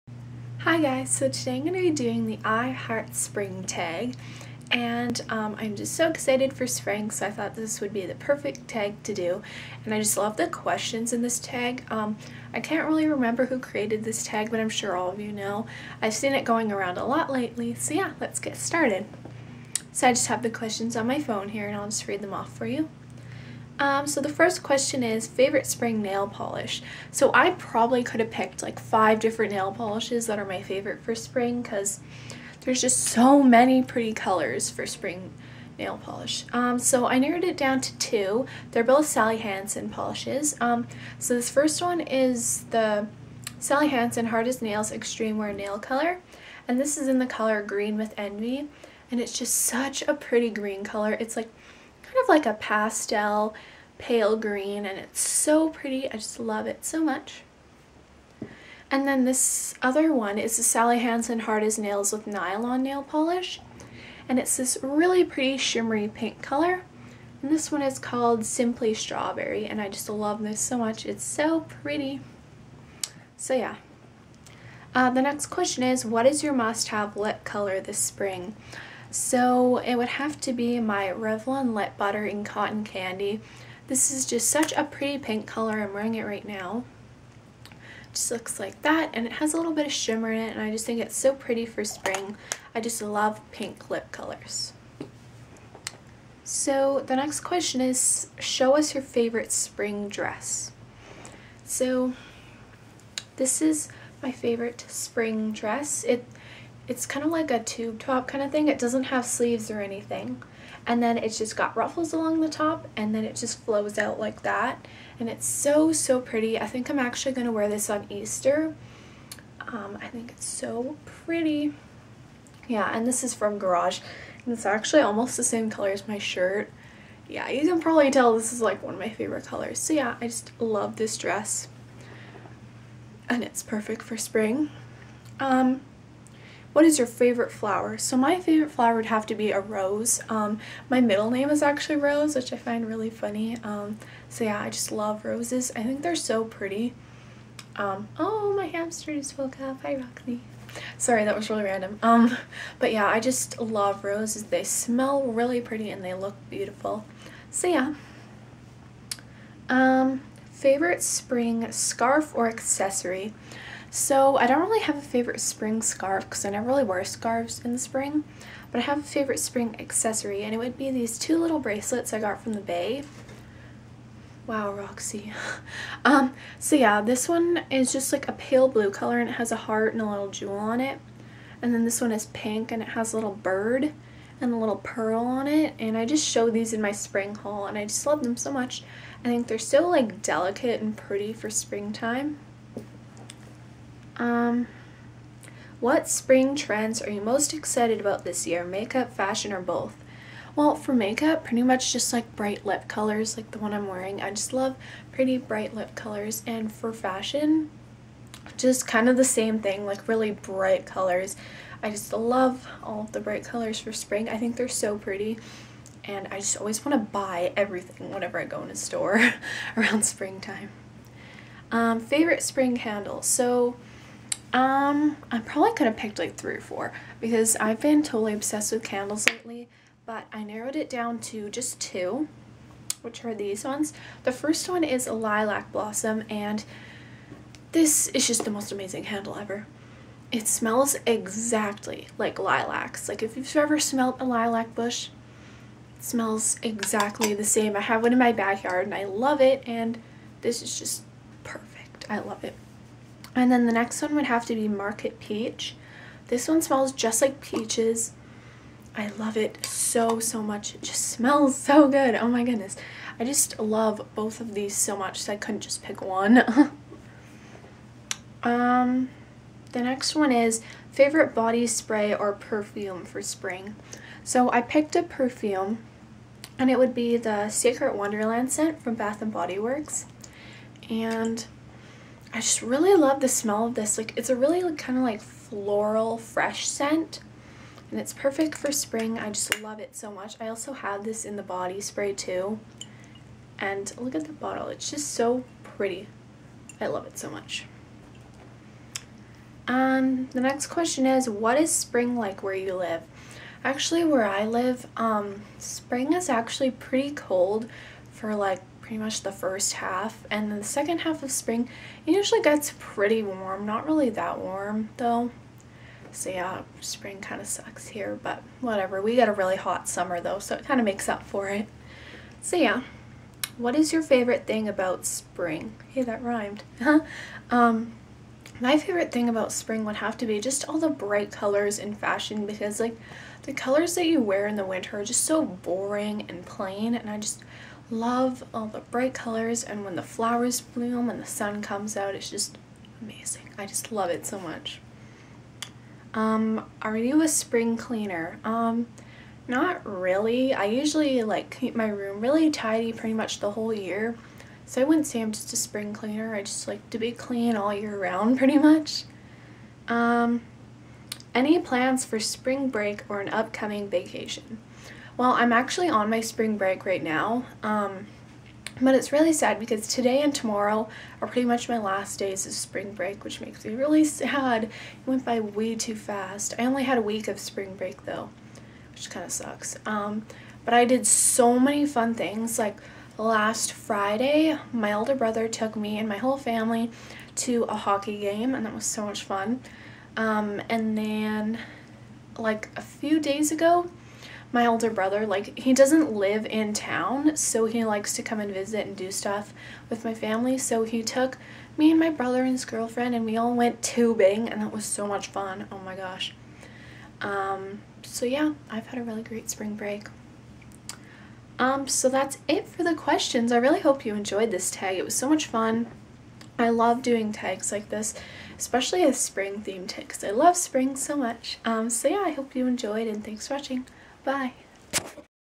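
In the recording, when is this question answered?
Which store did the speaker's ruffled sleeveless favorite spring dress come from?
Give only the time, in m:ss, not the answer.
2:03.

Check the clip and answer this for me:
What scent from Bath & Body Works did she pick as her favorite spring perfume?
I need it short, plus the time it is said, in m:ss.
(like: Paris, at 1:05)
Secret Wonderland, at 4:37.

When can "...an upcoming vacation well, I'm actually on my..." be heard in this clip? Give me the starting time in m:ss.
6:03.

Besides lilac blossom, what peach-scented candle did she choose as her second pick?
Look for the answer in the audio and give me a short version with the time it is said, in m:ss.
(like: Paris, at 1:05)
Market Peach, at 4:14.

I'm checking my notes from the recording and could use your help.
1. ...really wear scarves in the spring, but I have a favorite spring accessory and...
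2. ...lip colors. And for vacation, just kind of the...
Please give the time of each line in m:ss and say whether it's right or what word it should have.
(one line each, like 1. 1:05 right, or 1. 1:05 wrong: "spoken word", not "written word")
1. 2:46 right
2. 3:25 wrong: "fashion", not "vacation".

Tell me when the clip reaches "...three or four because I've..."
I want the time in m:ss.
3:46.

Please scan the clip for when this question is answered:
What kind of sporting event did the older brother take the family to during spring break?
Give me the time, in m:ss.
6:27.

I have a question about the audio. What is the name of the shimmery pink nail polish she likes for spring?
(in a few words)
Simply Strawberry.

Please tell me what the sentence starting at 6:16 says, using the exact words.
I only had a week of spring break though, which kind of sucks.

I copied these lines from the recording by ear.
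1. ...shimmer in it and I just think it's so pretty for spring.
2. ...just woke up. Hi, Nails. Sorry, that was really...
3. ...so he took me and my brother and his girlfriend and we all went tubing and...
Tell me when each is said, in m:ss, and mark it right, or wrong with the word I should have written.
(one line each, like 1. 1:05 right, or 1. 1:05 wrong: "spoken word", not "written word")
1. 1:29 right
2. 2:29 wrong: "Roxy", not "Nails"
3. 6:40 right.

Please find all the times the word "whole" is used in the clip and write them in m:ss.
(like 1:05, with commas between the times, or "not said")
5:53, 6:26.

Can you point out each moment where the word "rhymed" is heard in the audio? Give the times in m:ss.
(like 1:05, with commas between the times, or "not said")
5:26.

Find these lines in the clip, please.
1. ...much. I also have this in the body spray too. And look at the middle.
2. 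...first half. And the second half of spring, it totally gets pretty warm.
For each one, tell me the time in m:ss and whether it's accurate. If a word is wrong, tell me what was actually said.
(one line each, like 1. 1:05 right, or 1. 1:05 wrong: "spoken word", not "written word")
1. 4:50 wrong: "bottle", not "middle"
2. 5:09 wrong: "usually", not "totally".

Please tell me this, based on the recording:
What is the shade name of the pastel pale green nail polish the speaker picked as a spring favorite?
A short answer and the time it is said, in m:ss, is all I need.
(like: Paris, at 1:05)
Green with Envy, at 0:47.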